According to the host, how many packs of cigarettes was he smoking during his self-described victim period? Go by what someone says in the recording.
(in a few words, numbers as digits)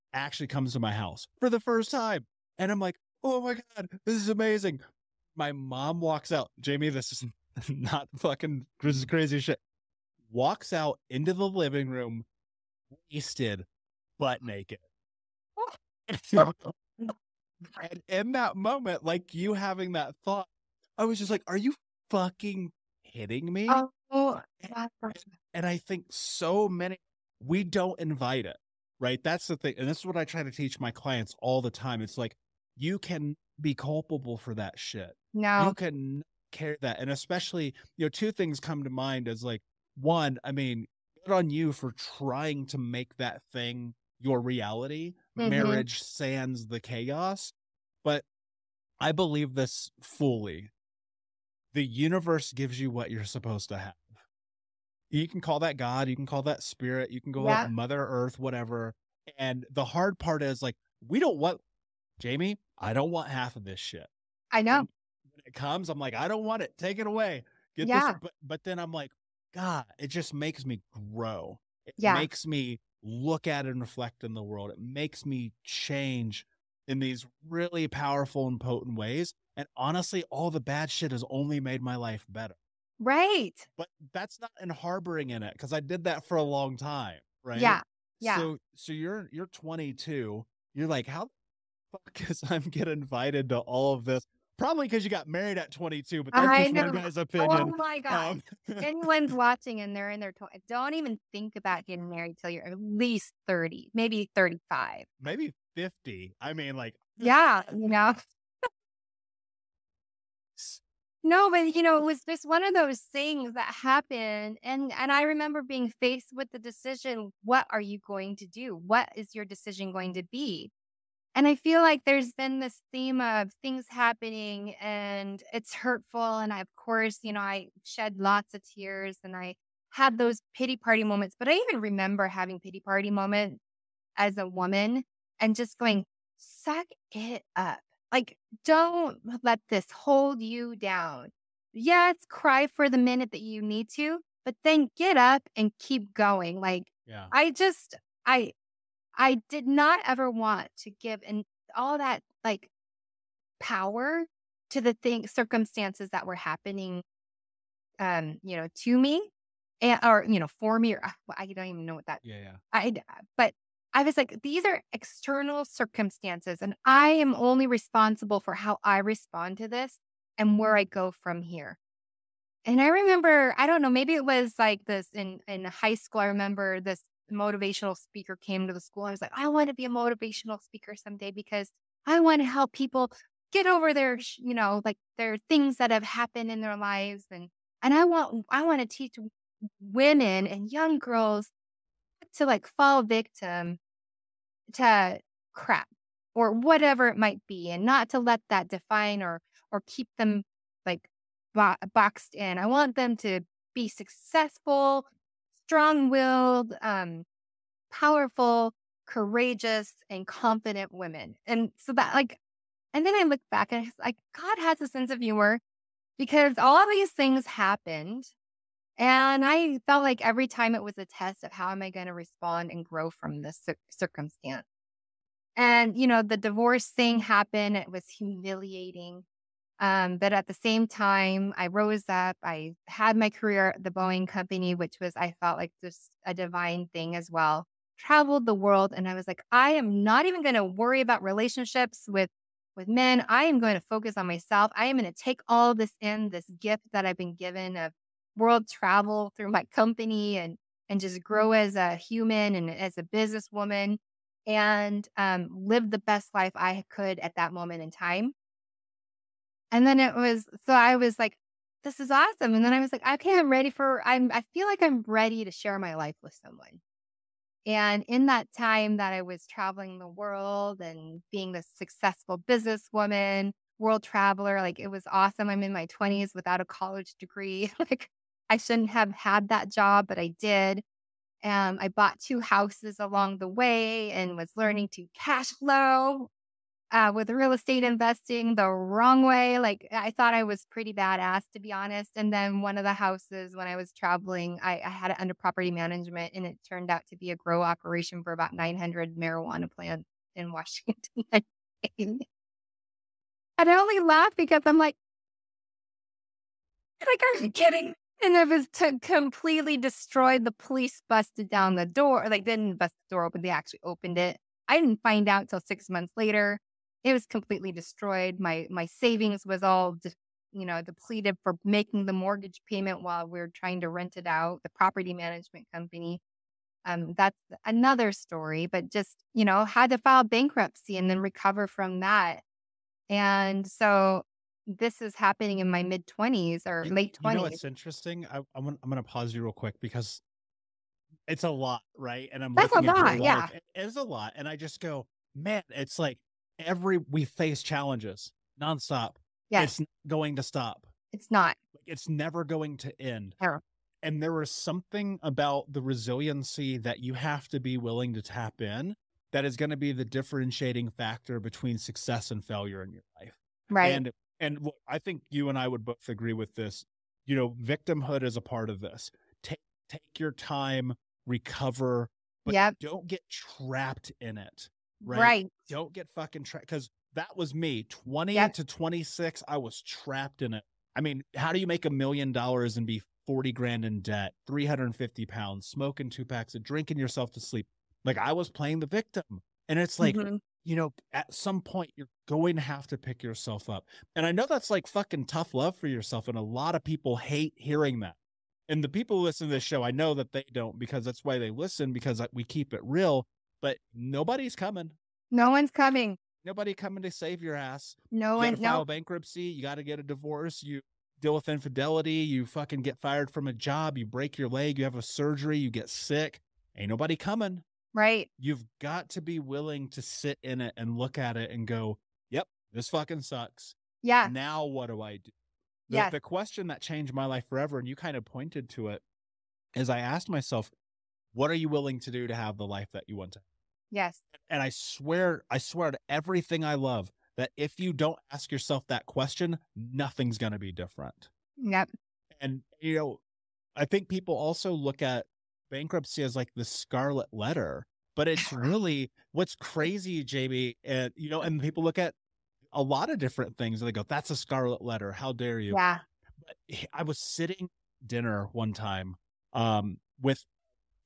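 2 packs.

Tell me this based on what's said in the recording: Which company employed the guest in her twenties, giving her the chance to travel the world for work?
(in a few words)
Boeing.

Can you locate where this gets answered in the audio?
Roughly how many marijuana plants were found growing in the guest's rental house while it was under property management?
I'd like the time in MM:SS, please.
04:58.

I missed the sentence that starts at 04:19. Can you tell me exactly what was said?
And then it was, so I was like, this is awesome.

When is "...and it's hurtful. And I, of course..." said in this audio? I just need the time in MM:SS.
02:04.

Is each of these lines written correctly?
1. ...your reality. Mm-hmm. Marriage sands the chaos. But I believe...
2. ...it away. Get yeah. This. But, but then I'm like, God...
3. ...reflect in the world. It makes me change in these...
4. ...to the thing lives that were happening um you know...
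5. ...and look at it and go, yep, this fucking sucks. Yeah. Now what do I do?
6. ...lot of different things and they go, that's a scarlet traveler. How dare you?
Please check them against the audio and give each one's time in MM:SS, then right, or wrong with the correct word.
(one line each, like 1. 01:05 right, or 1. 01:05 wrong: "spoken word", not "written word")
1. 00:44 right
2. 01:06 right
3. 01:13 right
4. 02:34 wrong: "circumstances", not "lives"
5. 07:00 right
6. 07:32 wrong: "letter", not "traveler".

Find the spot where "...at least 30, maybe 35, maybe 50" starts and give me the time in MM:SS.
01:42.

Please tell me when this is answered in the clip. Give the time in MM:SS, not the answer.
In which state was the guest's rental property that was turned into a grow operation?
05:00.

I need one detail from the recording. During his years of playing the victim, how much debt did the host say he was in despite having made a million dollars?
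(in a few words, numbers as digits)
40 grand.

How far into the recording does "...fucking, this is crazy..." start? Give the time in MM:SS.
00:08.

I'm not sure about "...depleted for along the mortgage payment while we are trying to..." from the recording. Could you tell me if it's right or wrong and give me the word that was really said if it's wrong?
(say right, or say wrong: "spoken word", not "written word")
wrong: "making", not "along".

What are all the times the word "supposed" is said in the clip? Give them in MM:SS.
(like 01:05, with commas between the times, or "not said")
00:53.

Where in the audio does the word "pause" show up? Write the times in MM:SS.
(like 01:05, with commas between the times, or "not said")
05:39.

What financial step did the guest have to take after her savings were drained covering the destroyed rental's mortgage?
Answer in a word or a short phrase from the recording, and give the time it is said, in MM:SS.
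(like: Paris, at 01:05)
File bankruptcy, at 05:29.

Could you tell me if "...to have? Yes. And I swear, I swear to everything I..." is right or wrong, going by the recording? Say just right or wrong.
right.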